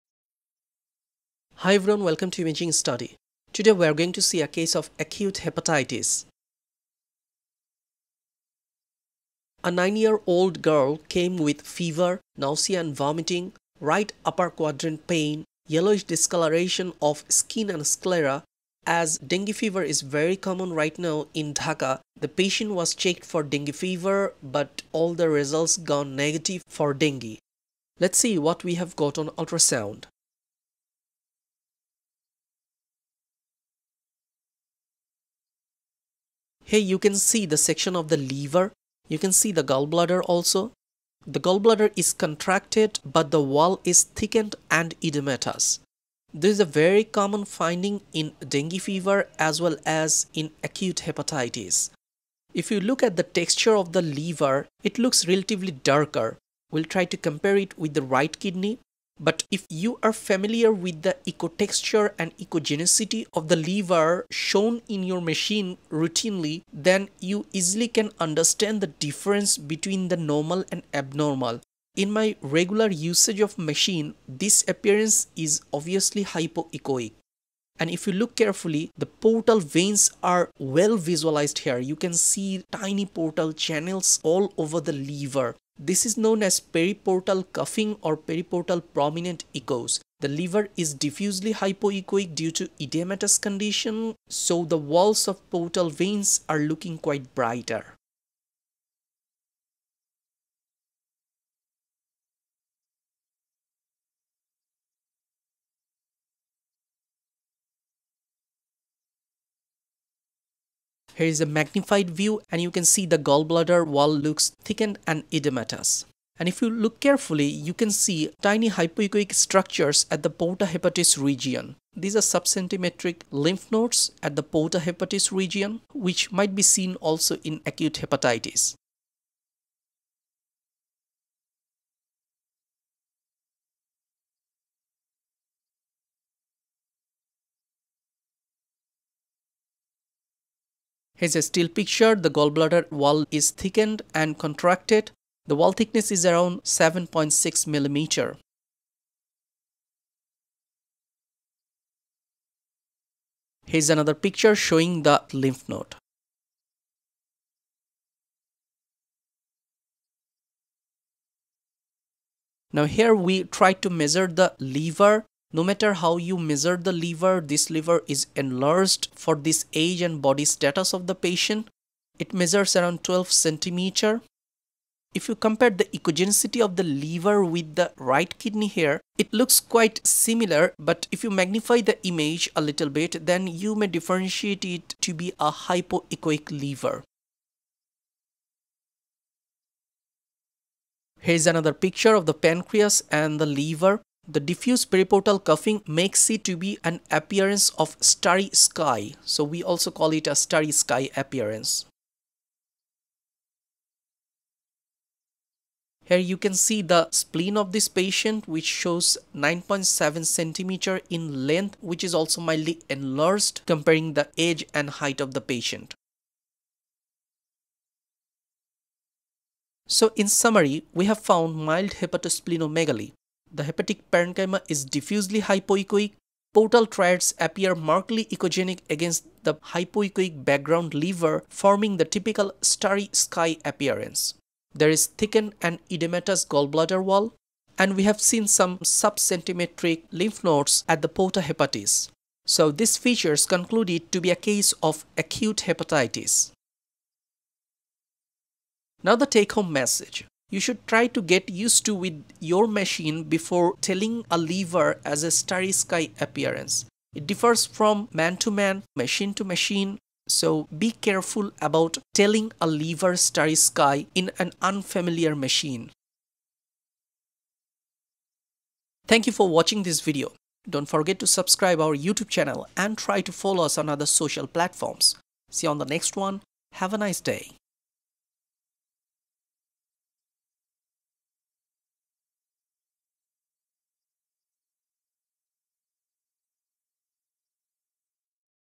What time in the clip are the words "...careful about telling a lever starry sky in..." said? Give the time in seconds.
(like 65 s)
260 s.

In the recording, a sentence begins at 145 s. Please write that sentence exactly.
The wall thickness is around 7.6 millimeter.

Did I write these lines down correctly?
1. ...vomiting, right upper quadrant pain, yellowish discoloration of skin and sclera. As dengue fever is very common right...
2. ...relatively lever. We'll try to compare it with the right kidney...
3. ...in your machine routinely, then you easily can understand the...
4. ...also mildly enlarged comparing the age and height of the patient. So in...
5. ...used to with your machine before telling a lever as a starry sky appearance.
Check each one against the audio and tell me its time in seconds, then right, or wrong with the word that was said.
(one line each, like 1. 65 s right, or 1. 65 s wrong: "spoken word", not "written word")
1. 12 s right
2. 55 s wrong: "darker", not "lever"
3. 64 s right
4. 212 s right
5. 251 s right.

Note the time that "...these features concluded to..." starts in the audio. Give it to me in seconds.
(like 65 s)
242 s.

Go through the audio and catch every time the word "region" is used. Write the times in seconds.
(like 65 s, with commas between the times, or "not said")
121 s, 125 s.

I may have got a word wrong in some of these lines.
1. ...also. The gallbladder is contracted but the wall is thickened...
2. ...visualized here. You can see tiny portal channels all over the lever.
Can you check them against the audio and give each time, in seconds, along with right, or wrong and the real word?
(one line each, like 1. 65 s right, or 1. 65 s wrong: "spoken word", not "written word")
1. 40 s right
2. 80 s right.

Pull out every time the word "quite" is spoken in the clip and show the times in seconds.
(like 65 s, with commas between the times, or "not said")
96 s, 179 s.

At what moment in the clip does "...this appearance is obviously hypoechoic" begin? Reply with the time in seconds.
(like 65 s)
74 s.